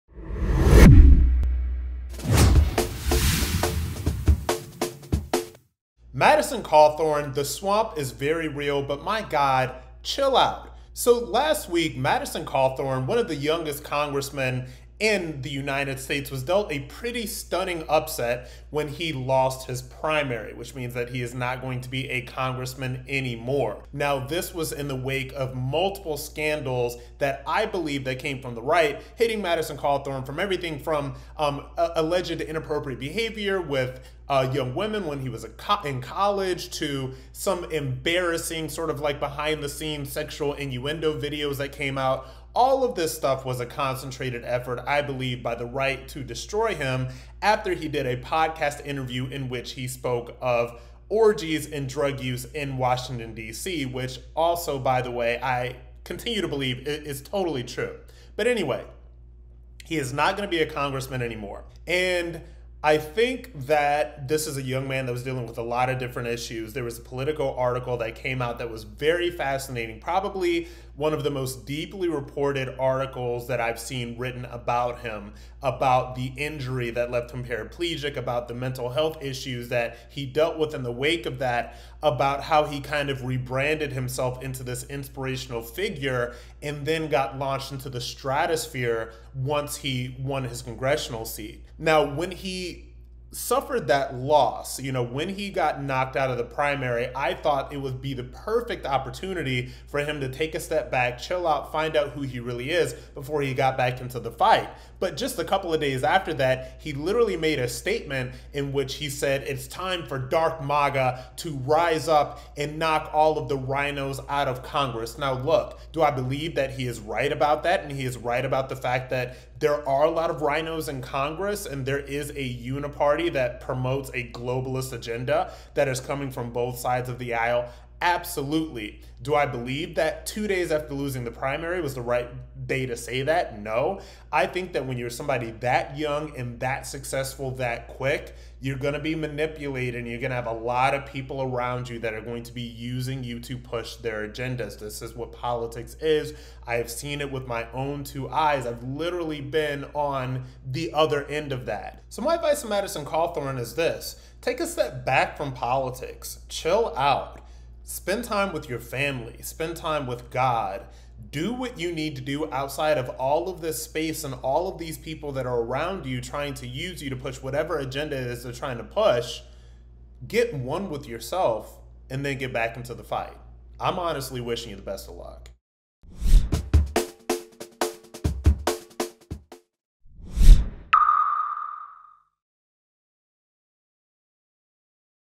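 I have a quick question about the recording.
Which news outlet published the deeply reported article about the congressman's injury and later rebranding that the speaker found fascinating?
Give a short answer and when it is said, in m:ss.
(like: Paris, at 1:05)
Politico, at 1:07.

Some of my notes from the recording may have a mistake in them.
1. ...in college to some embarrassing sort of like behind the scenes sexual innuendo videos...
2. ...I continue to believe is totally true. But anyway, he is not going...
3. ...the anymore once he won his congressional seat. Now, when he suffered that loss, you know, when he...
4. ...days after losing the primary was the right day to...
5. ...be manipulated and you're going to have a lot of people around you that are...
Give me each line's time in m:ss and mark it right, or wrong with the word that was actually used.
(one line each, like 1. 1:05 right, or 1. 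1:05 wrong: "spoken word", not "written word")
1. 0:35 right
2. 0:55 right
3. 1:27 wrong: "stratosphere", not "anymore"
4. 2:10 right
5. 2:18 right.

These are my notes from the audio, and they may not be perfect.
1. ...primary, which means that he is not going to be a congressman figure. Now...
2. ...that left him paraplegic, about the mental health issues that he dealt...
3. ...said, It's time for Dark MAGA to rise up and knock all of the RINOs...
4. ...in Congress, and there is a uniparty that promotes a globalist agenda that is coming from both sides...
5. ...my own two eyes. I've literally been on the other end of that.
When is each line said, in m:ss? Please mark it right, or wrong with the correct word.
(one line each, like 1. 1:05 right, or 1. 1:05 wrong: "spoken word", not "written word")
1. 0:19 wrong: "anymore", not "figure"
2. 1:16 right
3. 1:49 right
4. 2:00 right
5. 2:27 right.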